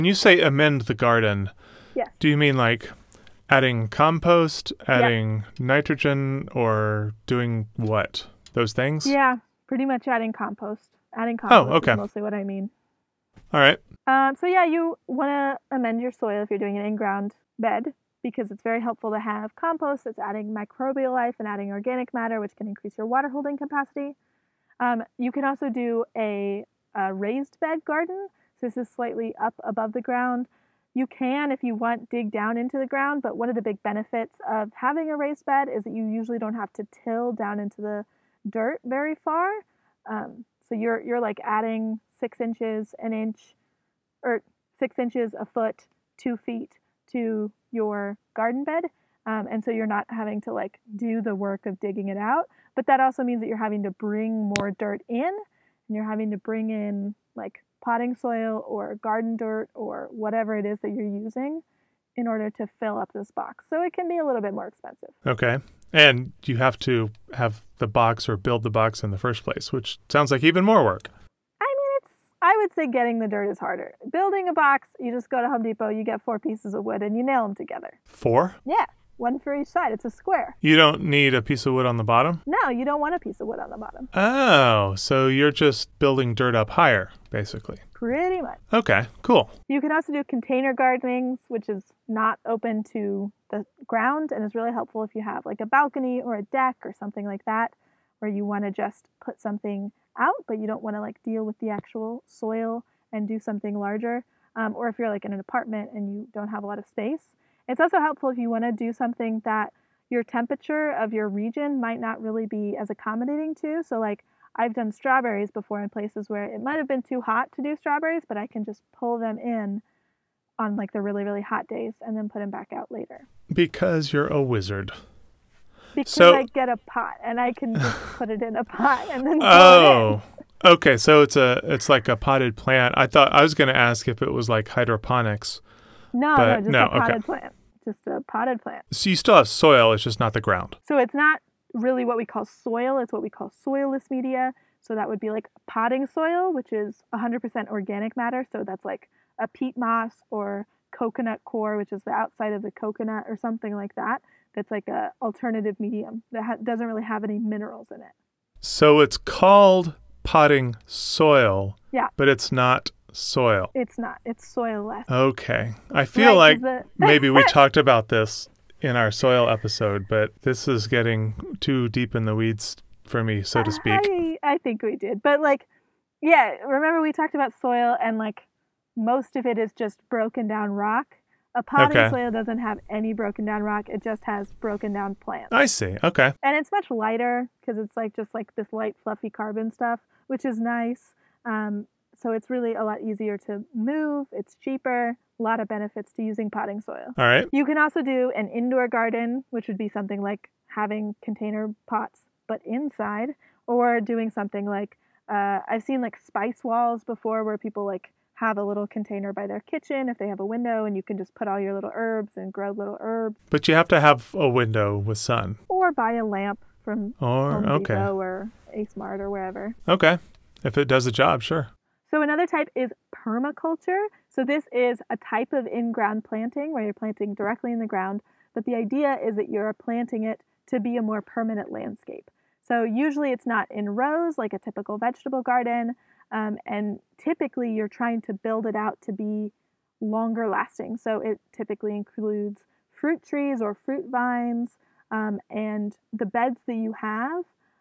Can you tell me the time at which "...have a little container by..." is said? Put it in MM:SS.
03:28.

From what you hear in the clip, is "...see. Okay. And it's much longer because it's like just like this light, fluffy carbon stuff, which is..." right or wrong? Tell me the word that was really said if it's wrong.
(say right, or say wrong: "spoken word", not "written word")
wrong: "lighter", not "longer".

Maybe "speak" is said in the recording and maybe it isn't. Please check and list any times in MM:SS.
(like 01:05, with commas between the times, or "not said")
02:53.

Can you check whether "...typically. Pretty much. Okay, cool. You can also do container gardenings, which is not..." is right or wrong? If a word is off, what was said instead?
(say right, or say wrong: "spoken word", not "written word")
wrong: "basically", not "typically".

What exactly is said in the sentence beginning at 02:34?
That's like an alternative medium that ha- doesn't really have any minerals in it.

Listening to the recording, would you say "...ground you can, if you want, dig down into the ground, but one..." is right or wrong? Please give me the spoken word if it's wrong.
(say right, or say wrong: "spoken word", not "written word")
right.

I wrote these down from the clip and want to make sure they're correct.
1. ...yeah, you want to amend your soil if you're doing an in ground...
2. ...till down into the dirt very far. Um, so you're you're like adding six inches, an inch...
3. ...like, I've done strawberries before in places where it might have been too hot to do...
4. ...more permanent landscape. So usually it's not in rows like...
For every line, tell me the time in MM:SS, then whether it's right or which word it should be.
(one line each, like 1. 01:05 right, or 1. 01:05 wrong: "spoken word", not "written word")
1. 00:14 right
2. 00:36 right
3. 01:53 right
4. 03:51 right.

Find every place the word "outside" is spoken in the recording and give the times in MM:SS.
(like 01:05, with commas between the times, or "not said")
02:32.